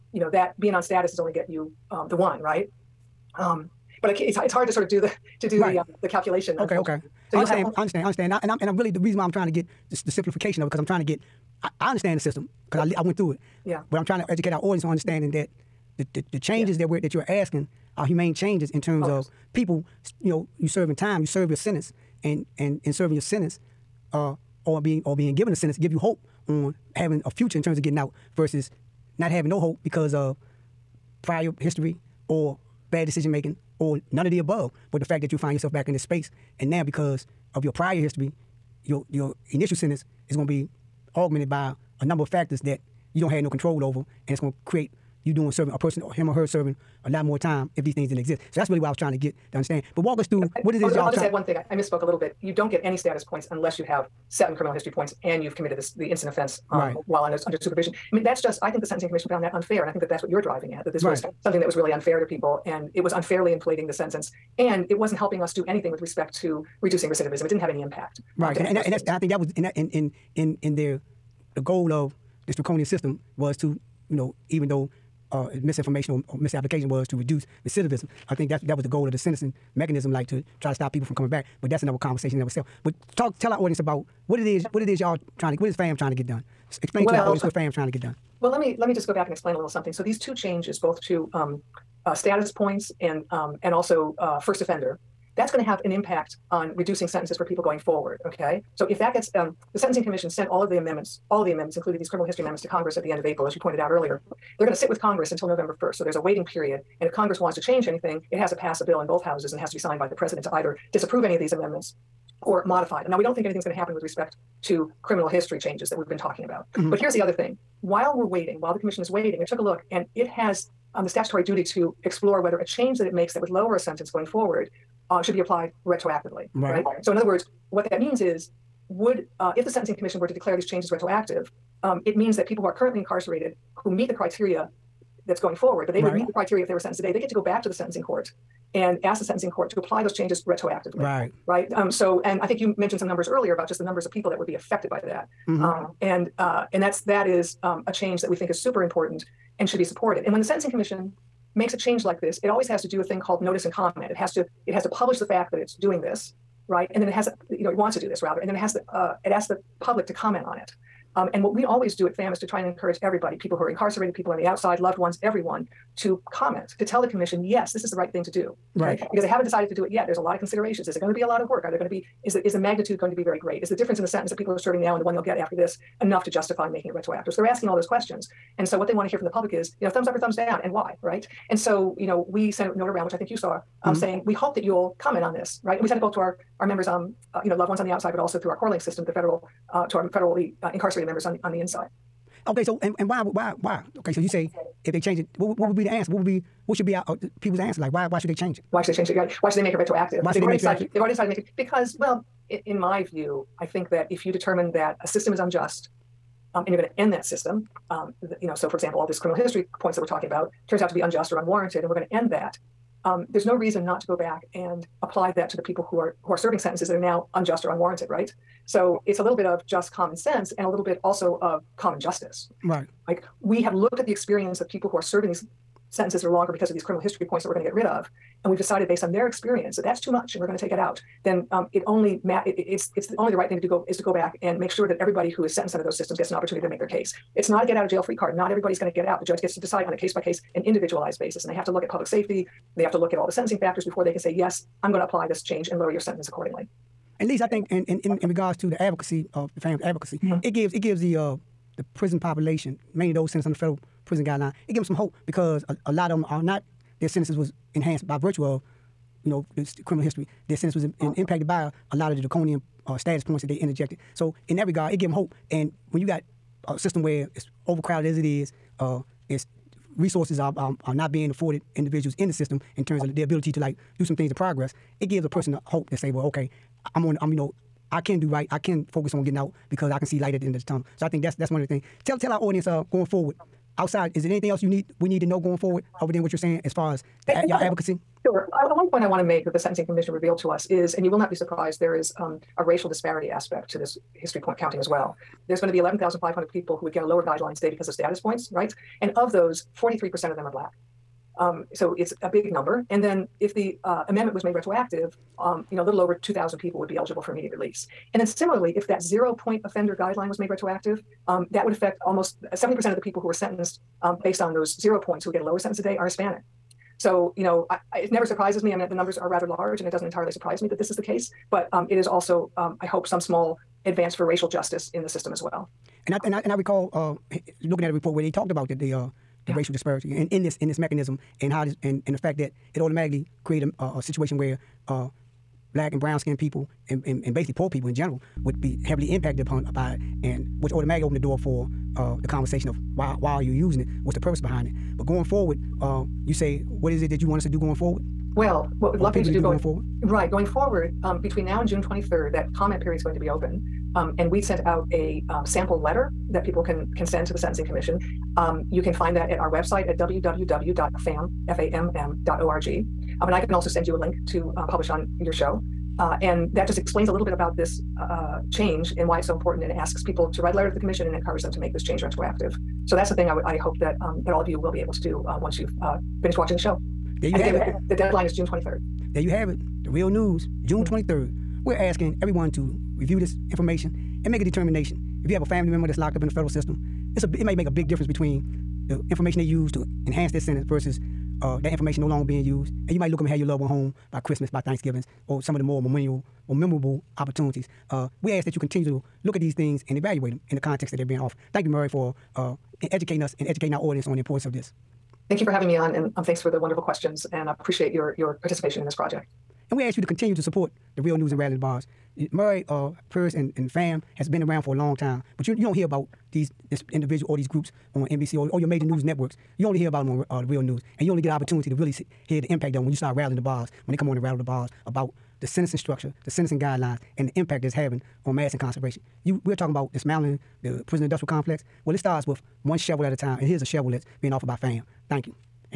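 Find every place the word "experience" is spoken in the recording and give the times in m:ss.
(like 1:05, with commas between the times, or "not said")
3:44, 3:49.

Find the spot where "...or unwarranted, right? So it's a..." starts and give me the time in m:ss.
3:37.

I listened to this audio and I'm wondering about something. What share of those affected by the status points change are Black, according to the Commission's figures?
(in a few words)
43%.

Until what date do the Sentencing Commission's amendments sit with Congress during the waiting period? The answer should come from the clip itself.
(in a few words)
November 1st.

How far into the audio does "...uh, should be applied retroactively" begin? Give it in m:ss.
2:05.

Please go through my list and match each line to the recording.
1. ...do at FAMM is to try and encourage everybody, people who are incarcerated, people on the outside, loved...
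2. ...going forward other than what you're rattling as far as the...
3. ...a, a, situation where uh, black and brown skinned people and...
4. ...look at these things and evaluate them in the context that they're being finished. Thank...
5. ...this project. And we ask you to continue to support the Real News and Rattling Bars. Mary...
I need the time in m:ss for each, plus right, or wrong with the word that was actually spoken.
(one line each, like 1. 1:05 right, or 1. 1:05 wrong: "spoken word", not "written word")
1. 2:41 right
2. 4:45 wrong: "saying", not "rattling"
3. 5:33 right
4. 6:39 wrong: "offered", not "finished"
5. 6:48 right.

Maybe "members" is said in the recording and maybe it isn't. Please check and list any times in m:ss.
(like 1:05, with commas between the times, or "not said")
3:06, 3:11, 6:25.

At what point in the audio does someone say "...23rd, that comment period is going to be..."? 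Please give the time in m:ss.
5:51.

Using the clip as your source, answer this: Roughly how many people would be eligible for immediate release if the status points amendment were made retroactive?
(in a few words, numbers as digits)
2,000.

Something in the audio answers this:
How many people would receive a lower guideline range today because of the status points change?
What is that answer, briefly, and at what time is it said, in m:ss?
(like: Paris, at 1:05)
11,500, at 4:55.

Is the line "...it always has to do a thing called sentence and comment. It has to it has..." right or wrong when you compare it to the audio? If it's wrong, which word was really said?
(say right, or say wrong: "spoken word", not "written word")
wrong: "notice", not "sentence".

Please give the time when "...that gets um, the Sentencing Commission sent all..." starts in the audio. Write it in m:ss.
1:38.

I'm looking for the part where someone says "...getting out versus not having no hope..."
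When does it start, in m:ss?
0:27.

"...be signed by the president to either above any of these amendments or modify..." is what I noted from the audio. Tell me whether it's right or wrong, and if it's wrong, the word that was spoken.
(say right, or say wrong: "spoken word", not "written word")
wrong: "disapprove", not "above".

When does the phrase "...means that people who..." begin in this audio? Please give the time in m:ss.
2:12.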